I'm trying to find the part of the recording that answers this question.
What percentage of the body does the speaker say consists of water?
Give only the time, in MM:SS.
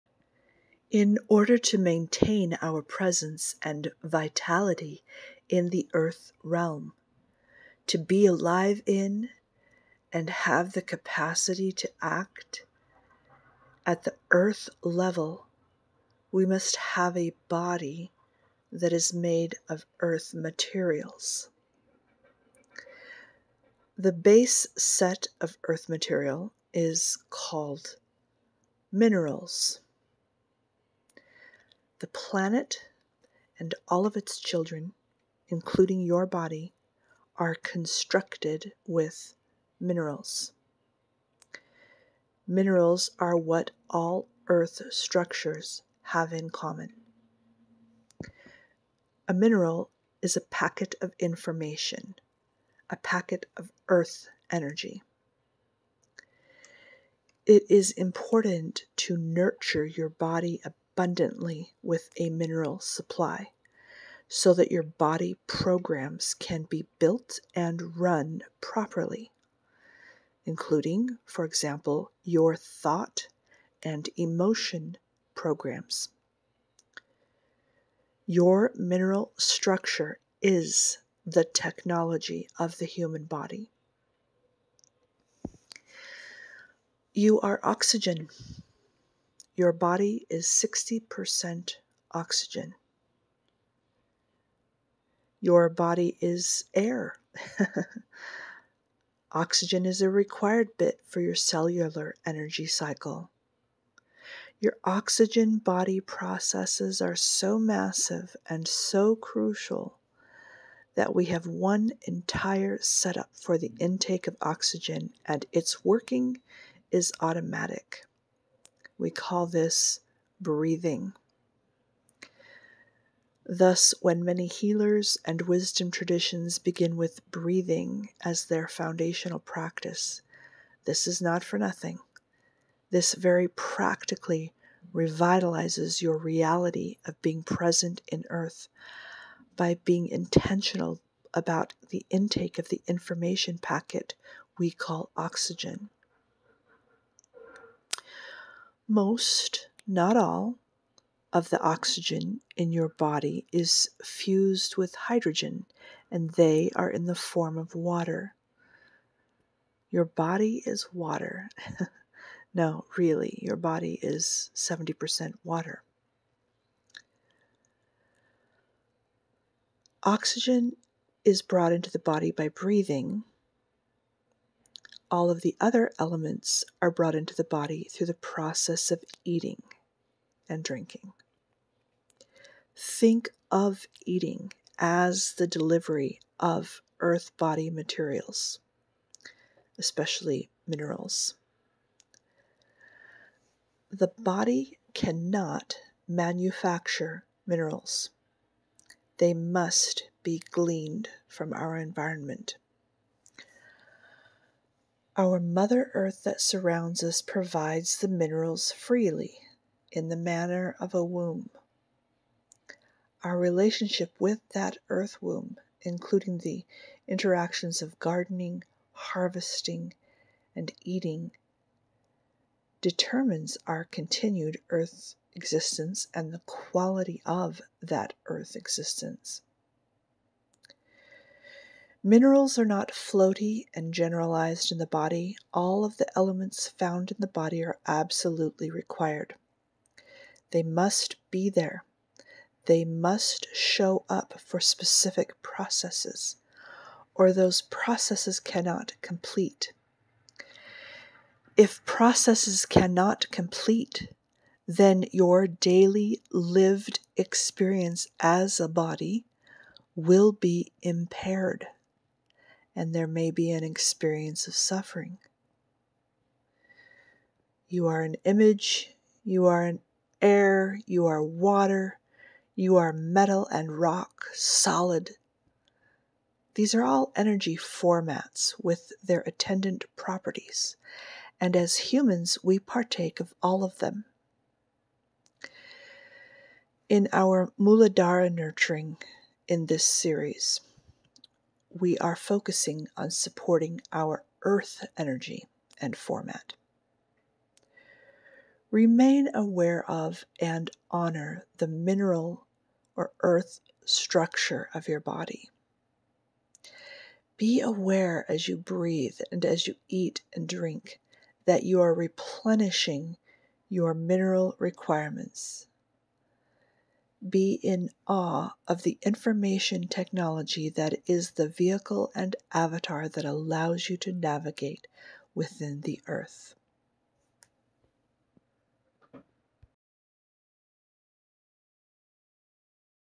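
02:44.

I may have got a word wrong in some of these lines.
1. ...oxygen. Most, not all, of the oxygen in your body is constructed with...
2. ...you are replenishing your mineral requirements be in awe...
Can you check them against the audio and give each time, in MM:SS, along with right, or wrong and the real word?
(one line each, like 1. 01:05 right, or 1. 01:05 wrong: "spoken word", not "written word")
1. 02:25 wrong: "fused", not "constructed"
2. 05:11 right.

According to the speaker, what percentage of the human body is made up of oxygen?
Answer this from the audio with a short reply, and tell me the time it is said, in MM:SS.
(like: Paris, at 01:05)
60%, at 01:30.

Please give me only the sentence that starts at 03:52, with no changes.
Minerals are not floaty and generalized in the body.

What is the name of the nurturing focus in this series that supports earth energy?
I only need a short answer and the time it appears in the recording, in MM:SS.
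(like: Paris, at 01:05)
Muladhara, at 04:47.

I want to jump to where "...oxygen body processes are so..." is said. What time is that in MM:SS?
01:44.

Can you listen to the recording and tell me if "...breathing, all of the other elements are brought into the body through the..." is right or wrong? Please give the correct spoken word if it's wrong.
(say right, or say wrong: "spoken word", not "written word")
right.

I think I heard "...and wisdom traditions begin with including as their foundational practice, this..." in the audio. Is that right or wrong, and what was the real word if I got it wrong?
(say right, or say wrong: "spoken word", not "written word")
wrong: "breathing", not "including".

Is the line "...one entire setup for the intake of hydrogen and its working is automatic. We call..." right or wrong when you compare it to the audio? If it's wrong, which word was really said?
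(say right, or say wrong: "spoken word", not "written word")
wrong: "oxygen", not "hydrogen".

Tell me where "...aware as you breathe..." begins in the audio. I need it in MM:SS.
05:07.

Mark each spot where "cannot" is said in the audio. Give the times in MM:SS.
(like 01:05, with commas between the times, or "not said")
03:14, 04:08, 04:12.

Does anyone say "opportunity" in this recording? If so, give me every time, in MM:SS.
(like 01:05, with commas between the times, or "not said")
not said.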